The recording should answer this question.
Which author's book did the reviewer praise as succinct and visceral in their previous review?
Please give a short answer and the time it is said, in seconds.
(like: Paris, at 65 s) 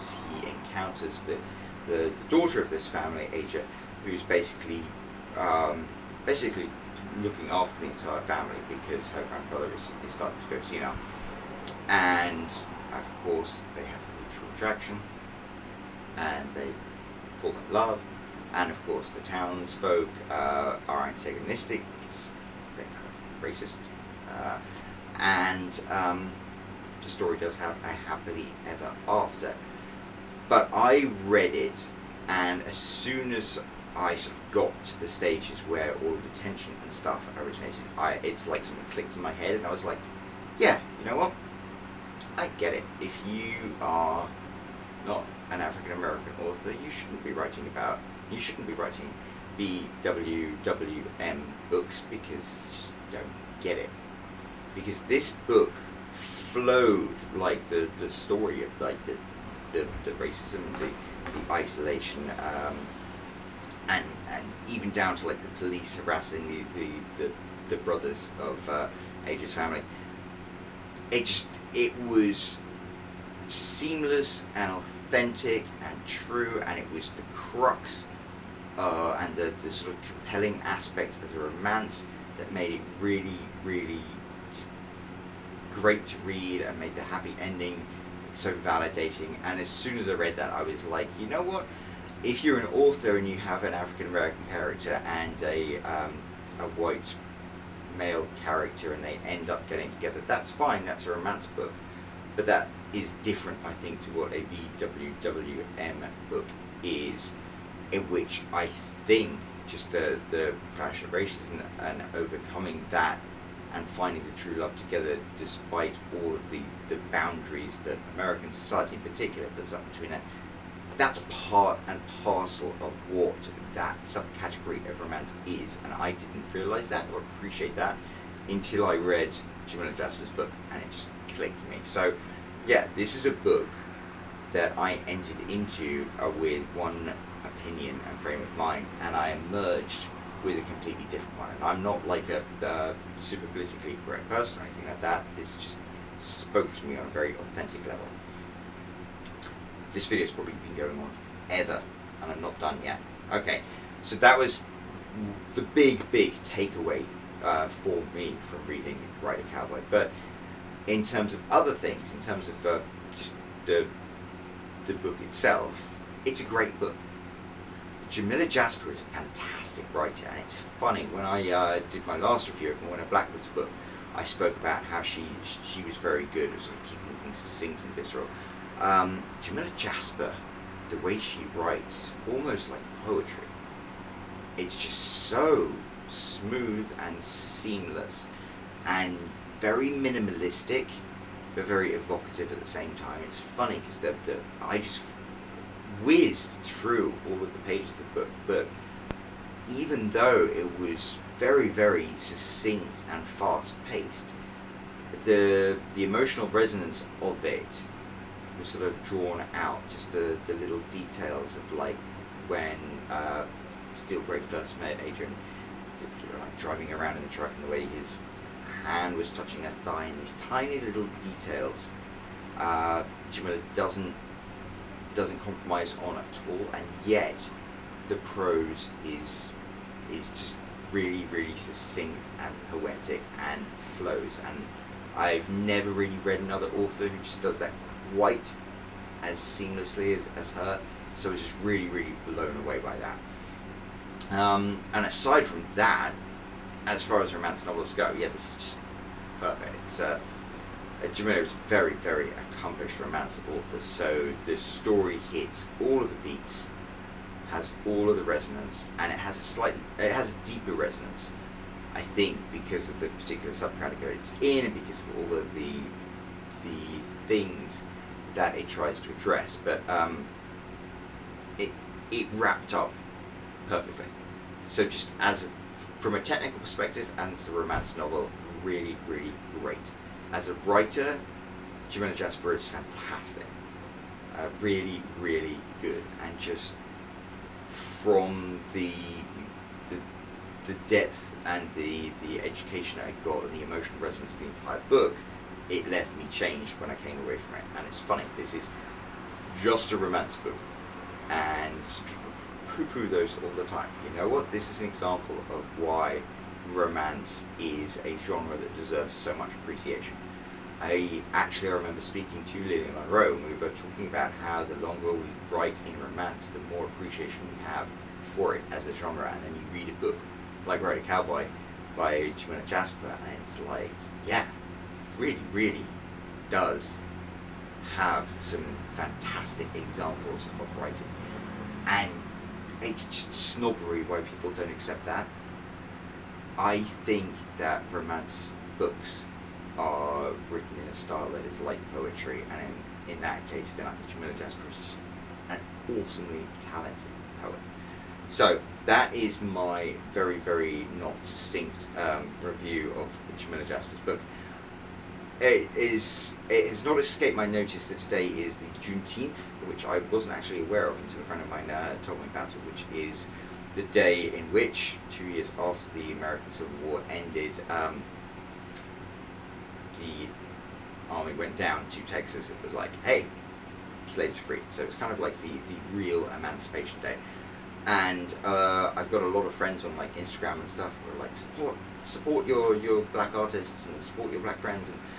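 Blackwood, at 173 s.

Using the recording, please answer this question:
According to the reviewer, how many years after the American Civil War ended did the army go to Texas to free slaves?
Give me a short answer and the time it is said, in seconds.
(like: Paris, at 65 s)
2, at 365 s.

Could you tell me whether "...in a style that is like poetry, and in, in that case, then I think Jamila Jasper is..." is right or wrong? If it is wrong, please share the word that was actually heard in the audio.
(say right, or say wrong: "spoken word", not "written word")
right.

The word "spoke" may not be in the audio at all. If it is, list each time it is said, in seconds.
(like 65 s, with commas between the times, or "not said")
146 s, 174 s.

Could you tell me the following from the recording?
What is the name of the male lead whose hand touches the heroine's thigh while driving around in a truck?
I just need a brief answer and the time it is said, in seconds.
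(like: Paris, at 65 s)
Adrian, at 215 s.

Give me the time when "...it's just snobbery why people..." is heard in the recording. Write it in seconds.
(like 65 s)
332 s.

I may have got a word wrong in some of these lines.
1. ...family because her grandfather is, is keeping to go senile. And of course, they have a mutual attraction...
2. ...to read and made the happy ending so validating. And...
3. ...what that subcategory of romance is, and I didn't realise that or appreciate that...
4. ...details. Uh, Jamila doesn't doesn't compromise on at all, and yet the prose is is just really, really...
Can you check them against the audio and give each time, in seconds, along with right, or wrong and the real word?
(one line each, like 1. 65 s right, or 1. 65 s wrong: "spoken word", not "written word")
1. 8 s wrong: "starting", not "keeping"
2. 86 s right
3. 123 s right
4. 221 s right.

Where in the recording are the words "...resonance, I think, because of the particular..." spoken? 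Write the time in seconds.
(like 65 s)
260 s.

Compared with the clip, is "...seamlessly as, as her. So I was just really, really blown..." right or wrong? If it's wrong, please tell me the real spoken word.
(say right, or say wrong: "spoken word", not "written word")
right.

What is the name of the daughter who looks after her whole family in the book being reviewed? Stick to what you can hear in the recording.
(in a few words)
Asia.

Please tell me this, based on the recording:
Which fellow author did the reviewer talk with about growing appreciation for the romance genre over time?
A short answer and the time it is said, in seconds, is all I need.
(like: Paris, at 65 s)
Lillian Monroe, at 312 s.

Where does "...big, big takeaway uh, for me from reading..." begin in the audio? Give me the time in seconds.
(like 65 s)
155 s.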